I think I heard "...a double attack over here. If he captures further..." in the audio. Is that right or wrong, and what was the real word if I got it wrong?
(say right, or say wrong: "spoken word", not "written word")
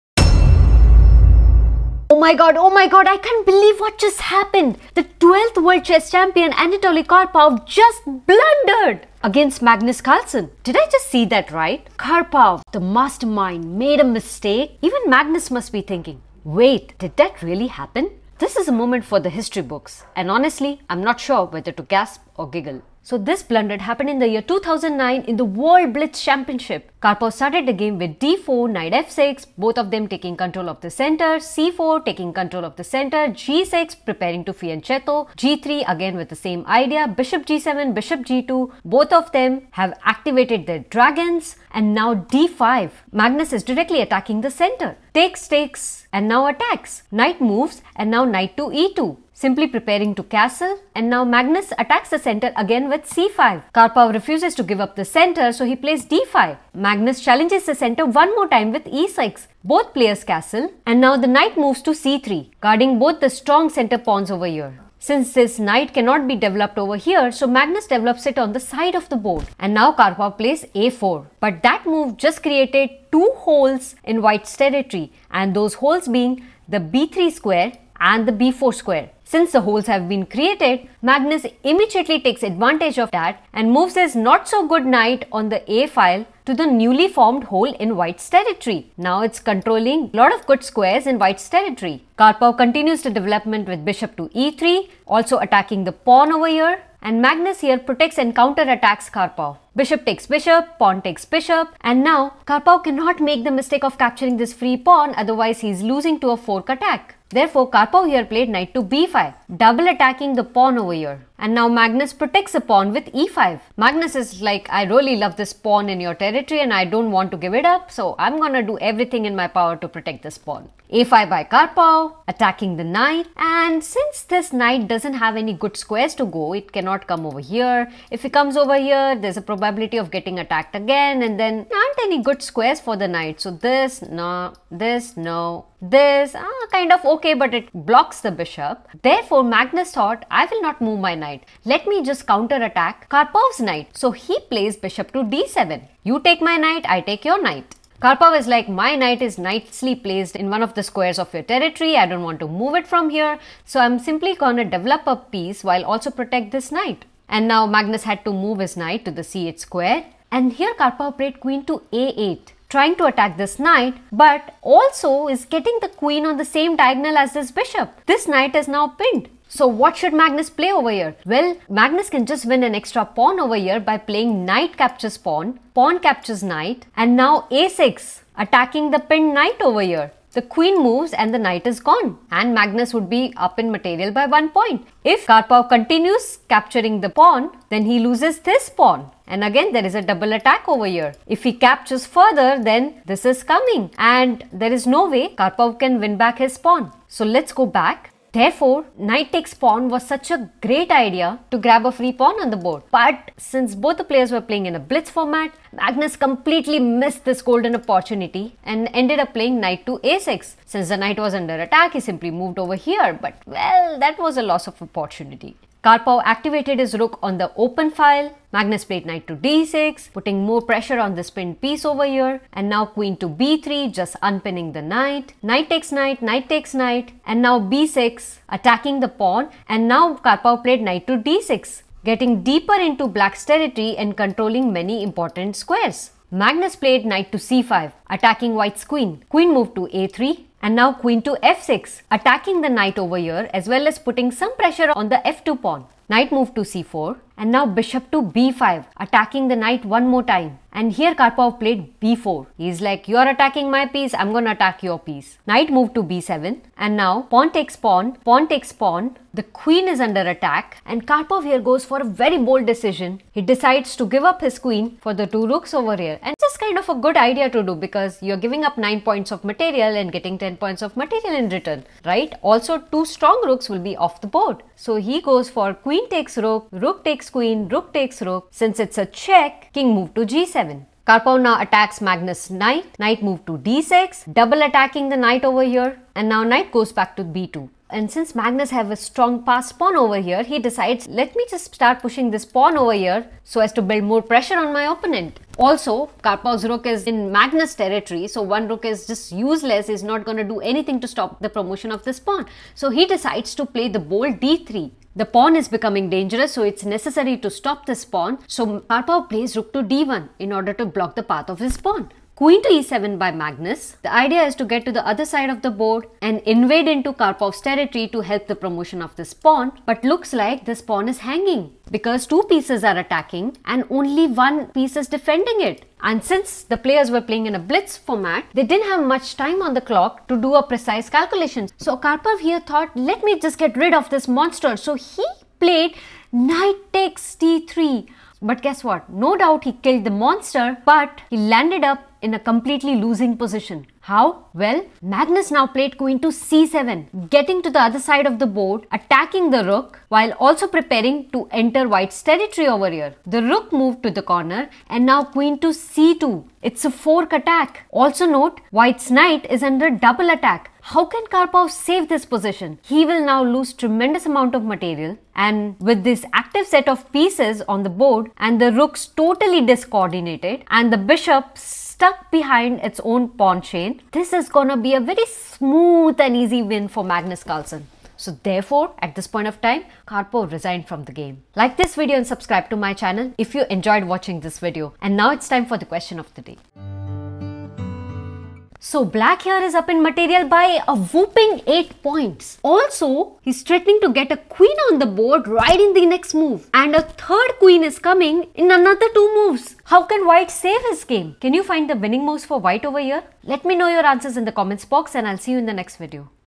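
right.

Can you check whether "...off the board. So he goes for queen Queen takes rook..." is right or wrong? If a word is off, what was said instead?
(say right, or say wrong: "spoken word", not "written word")
right.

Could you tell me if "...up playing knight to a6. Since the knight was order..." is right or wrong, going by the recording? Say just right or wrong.
wrong.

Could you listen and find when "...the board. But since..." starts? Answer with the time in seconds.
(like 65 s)
202 s.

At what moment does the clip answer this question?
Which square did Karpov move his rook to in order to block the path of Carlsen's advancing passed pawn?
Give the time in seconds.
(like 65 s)
309 s.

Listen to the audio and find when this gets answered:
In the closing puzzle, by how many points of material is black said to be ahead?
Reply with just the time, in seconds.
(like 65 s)
391 s.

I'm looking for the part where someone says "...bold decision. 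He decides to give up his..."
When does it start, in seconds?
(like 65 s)
262 s.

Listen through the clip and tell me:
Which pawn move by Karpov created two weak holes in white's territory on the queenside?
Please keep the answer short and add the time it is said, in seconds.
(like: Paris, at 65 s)
a4, at 70 s.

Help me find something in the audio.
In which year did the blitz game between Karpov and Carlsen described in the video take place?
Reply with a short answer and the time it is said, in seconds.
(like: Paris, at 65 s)
2009, at 24 s.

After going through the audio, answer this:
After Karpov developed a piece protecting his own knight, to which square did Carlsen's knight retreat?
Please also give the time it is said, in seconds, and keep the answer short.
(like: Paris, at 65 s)
c8, at 159 s.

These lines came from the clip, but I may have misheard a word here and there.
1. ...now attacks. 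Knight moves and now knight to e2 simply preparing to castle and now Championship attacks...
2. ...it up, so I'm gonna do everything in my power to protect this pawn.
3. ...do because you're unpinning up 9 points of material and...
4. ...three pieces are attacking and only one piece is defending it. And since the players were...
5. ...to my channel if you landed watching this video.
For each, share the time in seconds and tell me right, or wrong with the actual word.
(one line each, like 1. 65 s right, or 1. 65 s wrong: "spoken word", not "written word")
1. 46 s wrong: "Magnus", not "Championship"
2. 117 s right
3. 267 s wrong: "giving", not "unpinning"
4. 322 s wrong: "two", not "three"
5. 382 s wrong: "enjoyed", not "landed".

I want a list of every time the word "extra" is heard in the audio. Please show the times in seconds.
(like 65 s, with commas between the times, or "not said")
172 s.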